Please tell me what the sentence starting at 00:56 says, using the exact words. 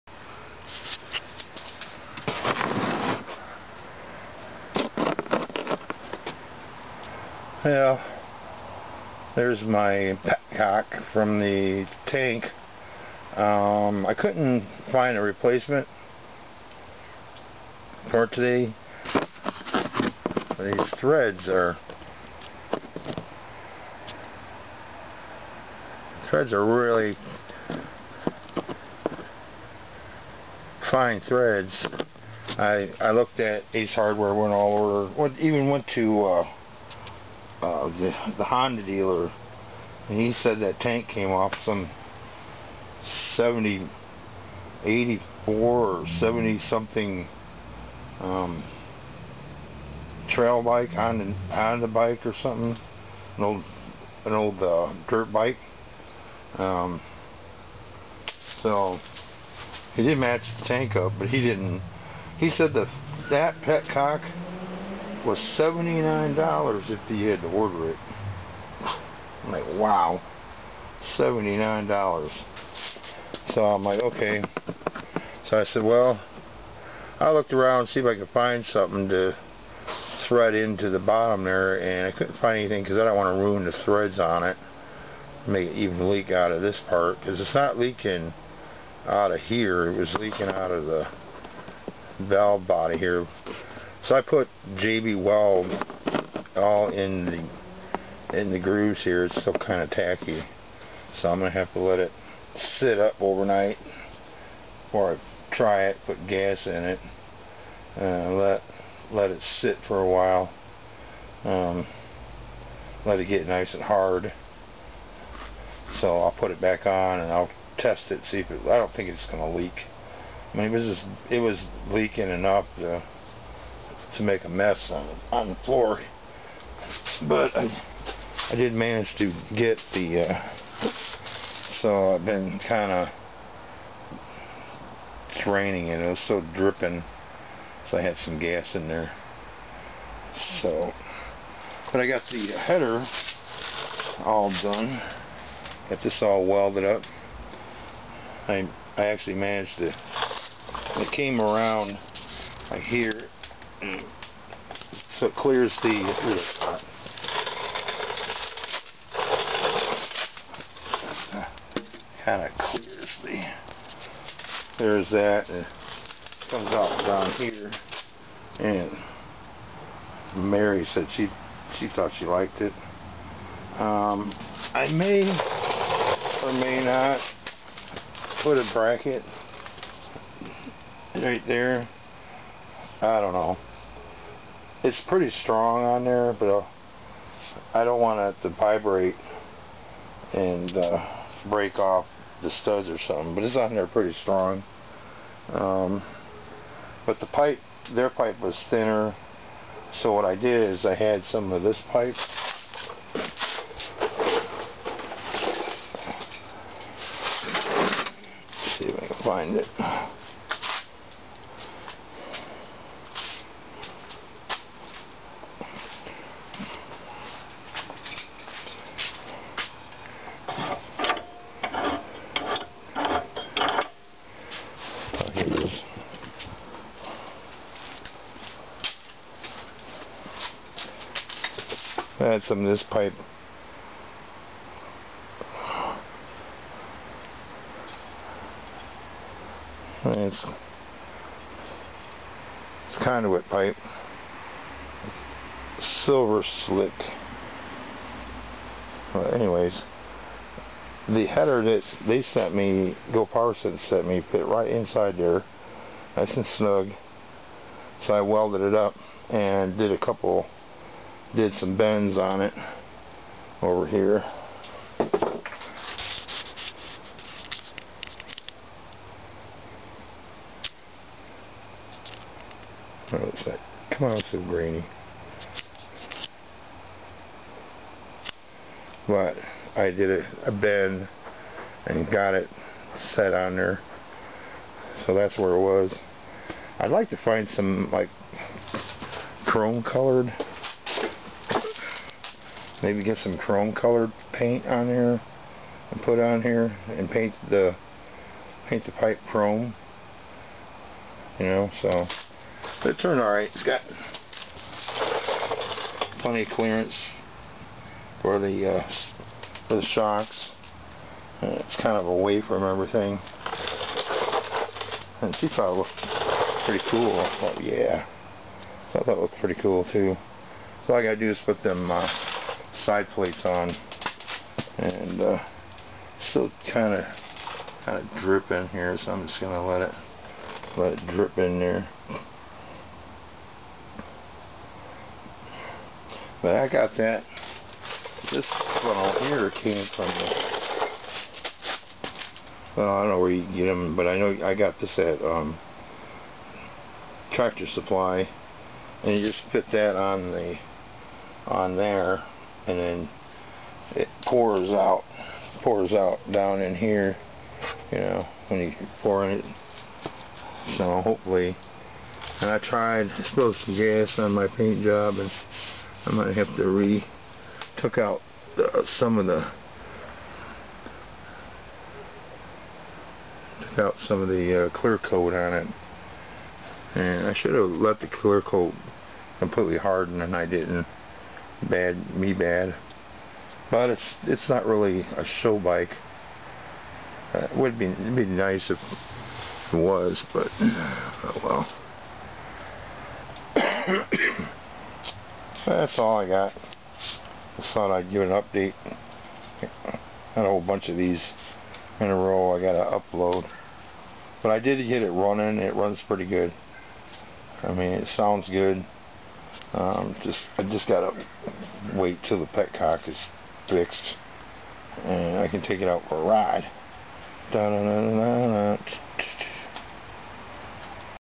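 Um, so he did match the tank up, but he didn't.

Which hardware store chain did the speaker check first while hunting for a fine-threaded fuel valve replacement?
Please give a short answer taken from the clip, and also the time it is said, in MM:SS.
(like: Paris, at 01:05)
Ace Hardware, at 00:33.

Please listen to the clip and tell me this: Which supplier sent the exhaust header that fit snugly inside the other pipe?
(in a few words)
Go Parson.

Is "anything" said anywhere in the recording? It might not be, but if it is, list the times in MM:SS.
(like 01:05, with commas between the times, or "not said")
01:22.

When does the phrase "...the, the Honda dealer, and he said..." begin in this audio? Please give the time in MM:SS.
00:37.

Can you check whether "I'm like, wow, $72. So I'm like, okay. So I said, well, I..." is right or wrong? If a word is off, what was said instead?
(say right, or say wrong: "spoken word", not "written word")
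wrong: "79", not "72".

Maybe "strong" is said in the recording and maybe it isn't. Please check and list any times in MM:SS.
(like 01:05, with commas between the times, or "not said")
03:05, 03:14.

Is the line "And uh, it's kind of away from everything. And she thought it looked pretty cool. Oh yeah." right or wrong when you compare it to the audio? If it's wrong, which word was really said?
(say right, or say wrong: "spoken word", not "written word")
right.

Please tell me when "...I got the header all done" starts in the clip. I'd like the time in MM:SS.
02:22.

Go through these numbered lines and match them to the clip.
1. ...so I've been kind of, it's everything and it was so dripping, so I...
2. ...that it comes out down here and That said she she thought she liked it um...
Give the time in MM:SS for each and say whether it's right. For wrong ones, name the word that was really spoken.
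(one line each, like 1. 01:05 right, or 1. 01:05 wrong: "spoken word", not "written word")
1. 02:11 wrong: "raining", not "everything"
2. 02:45 wrong: "Mary", not "That".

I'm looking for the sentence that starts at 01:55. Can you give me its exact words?
So I'll put it back on and I'll test it, see if it, I don't think it's going to leak.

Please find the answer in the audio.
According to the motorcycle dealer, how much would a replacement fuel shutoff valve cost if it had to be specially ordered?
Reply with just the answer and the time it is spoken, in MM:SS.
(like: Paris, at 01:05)
$79, at 01:05.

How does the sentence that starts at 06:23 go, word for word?
But it's it's not really a show bike.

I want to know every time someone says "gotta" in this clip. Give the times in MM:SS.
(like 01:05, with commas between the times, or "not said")
05:21, 06:42, 06:50.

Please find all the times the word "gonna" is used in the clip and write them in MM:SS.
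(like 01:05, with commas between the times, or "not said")
05:29.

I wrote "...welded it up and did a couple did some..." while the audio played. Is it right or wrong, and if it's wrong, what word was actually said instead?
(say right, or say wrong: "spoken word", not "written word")
right.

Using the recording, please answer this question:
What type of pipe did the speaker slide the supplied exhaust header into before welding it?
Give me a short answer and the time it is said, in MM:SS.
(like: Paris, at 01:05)
Conduit pipe, at 04:02.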